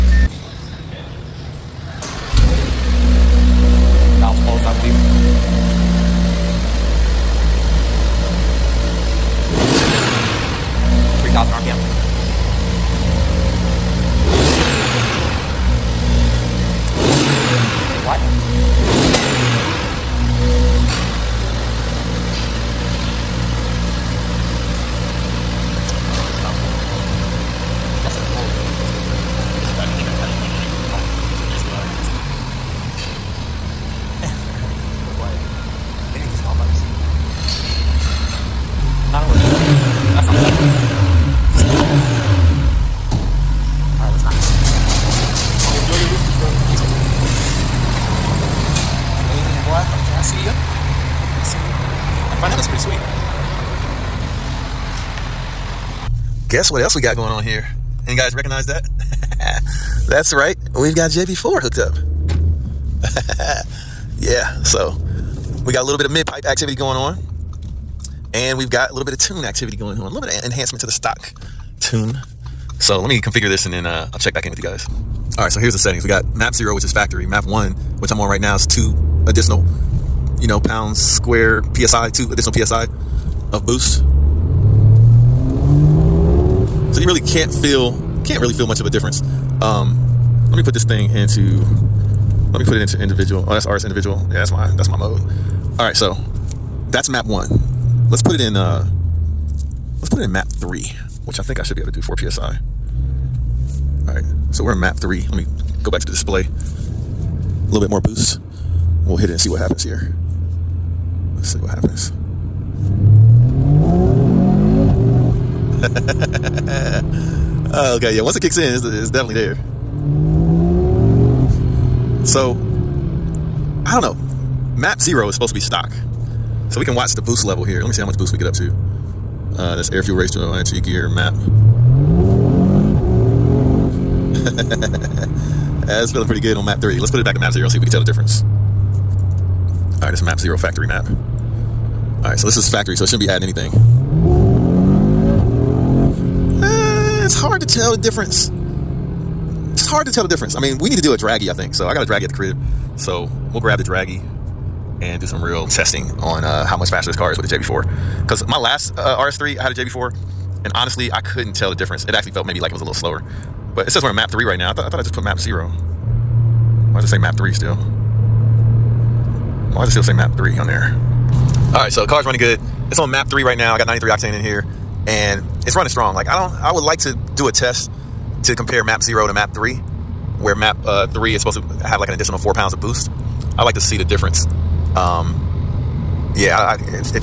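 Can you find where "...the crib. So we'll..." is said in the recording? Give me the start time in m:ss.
2:32.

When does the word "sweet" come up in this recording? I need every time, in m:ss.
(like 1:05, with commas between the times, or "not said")
0:52.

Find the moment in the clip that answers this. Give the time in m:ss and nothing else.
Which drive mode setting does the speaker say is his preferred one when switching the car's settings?
1:33.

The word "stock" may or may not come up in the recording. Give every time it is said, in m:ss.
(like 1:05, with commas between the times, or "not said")
1:10, 2:05.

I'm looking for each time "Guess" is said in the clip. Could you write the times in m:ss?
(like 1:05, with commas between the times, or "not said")
0:56.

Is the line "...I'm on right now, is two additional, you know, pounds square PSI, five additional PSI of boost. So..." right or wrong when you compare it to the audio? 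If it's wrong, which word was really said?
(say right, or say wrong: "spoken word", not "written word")
wrong: "two", not "five".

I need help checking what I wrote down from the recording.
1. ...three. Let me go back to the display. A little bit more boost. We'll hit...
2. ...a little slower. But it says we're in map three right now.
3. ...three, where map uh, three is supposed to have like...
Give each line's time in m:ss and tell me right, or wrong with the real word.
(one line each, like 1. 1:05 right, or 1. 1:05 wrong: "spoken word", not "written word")
1. 1:44 right
2. 2:42 right
3. 2:59 right.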